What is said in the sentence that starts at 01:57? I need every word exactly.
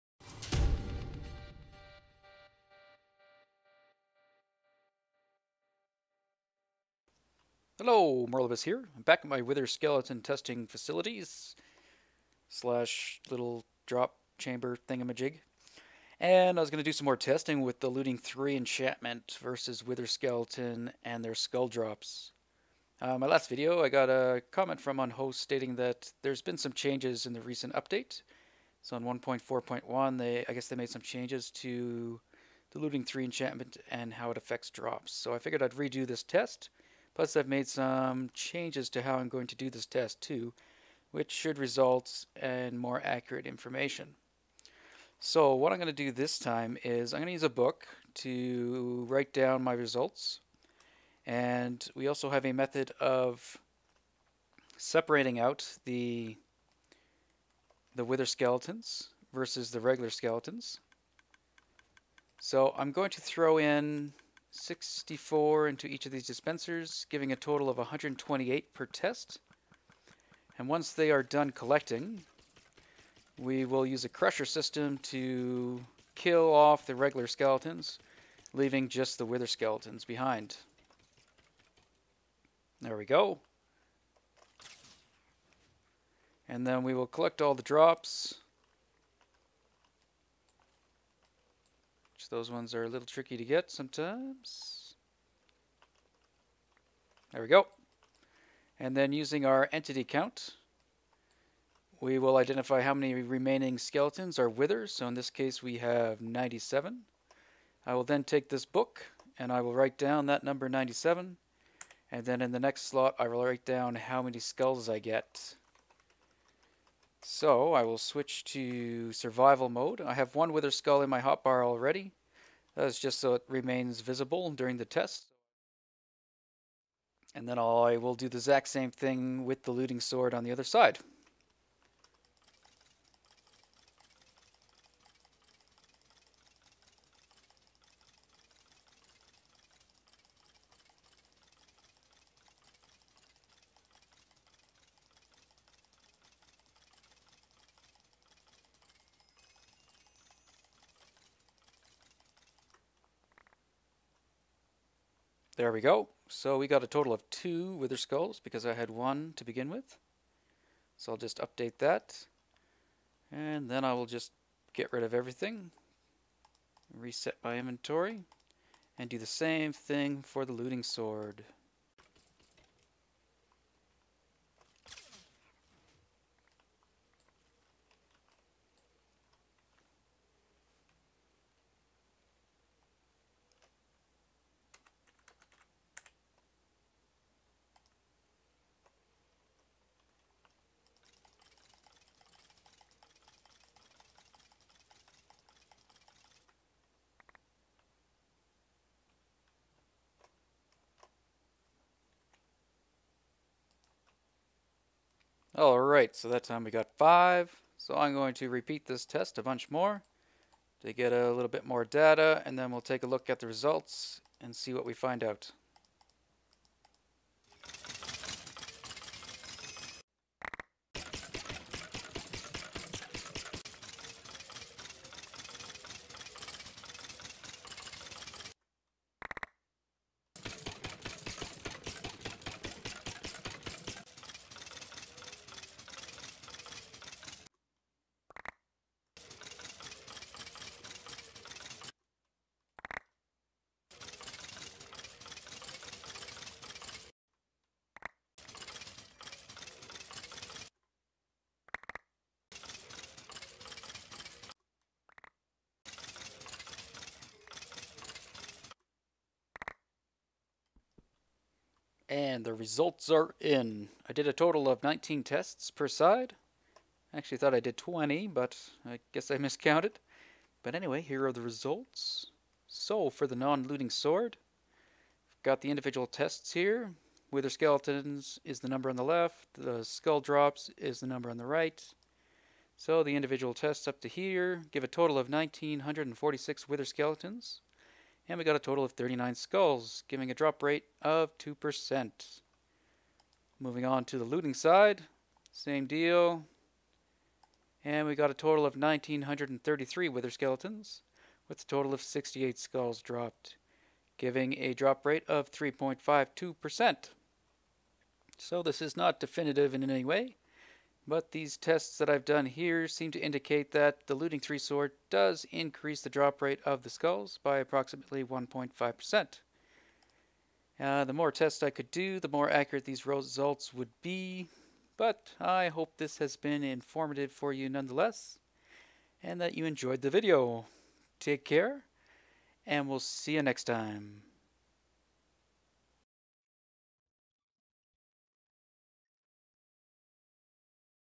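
So I will switch to survival mode.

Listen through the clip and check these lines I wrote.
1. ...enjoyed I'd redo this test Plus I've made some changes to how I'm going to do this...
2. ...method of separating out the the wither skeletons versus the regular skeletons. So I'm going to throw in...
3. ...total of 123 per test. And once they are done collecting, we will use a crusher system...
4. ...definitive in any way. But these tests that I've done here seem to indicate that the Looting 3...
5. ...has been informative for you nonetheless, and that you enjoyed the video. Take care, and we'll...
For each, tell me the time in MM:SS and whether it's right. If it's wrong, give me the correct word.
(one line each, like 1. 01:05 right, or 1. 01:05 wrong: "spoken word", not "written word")
1. 00:35 wrong: "figured", not "enjoyed"
2. 00:52 right
3. 01:07 wrong: "128", not "123"
4. 05:09 right
5. 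05:26 right.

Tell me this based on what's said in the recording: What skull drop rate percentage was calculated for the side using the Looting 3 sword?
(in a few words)
3.52%.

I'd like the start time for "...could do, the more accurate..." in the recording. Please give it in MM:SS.
05:21.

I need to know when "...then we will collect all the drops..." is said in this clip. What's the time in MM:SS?
01:26.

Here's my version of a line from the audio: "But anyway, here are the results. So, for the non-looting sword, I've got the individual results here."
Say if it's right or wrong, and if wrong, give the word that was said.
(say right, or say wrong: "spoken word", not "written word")
wrong: "tests", not "results".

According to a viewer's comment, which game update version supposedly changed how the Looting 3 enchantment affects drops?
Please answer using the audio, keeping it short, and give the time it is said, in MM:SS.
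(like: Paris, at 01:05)
1.4.1, at 00:29.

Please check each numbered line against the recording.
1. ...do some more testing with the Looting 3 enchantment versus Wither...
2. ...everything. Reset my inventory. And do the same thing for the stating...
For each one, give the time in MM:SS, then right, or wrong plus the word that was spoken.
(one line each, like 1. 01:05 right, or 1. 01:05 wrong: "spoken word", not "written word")
1. 00:16 right
2. 02:45 wrong: "looting", not "stating".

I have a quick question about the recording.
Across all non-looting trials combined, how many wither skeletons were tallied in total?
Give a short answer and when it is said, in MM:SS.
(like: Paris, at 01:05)
1,946, at 04:45.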